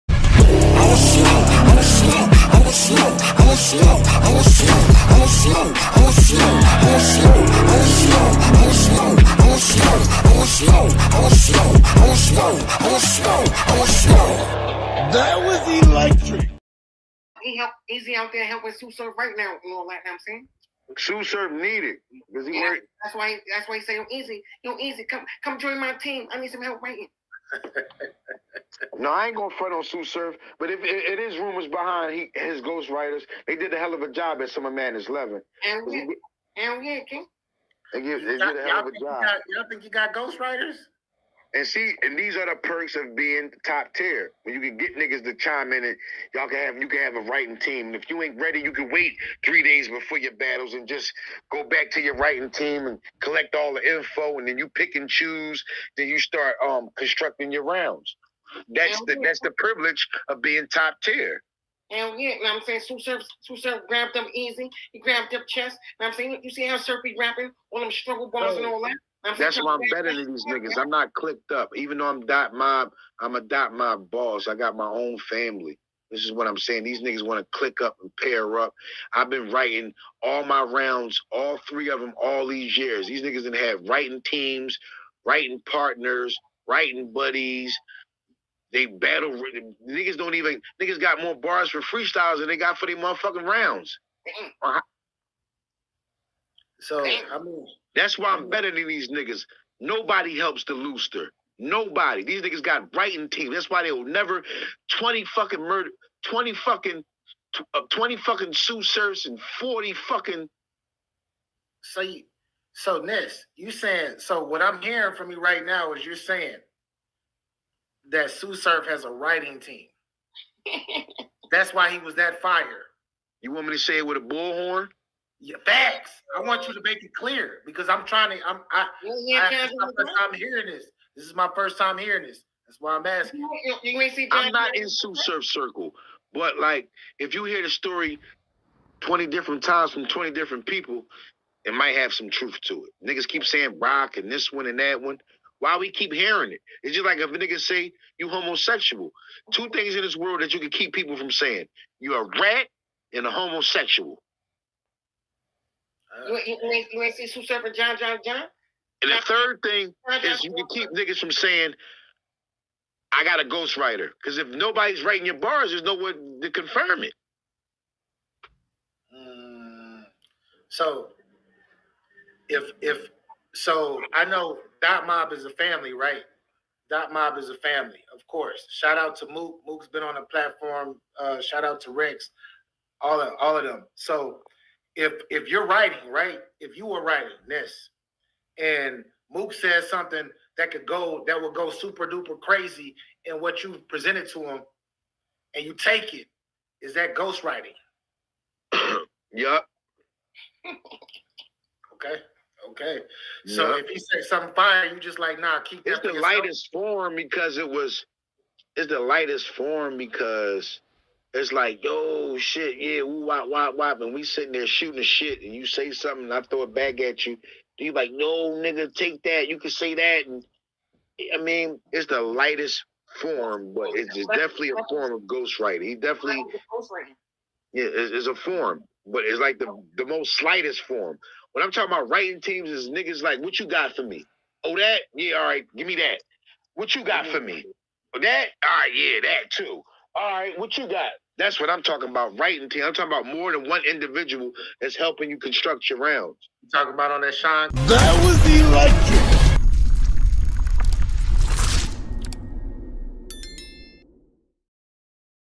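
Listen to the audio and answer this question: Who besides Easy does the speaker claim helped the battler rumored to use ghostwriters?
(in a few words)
Chess.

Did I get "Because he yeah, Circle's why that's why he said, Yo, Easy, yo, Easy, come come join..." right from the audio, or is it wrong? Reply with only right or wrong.
wrong.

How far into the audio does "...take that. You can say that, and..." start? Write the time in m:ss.
3:38.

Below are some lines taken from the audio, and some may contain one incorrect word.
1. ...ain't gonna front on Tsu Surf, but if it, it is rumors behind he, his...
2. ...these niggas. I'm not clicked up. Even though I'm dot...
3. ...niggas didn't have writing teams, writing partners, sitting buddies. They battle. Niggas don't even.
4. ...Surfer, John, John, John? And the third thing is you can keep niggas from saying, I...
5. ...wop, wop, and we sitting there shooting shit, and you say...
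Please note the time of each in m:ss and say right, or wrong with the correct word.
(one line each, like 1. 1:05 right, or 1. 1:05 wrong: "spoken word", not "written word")
1. 0:29 right
2. 1:10 right
3. 1:23 wrong: "writing", not "sitting"
4. 2:37 right
5. 3:33 right.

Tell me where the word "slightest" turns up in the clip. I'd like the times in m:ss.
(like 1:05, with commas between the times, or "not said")
3:50.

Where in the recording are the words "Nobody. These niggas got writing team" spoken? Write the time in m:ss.
1:41.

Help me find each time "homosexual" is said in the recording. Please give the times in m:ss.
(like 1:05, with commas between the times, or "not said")
2:28, 2:33.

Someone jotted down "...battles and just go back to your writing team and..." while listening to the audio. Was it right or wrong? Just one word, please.
right.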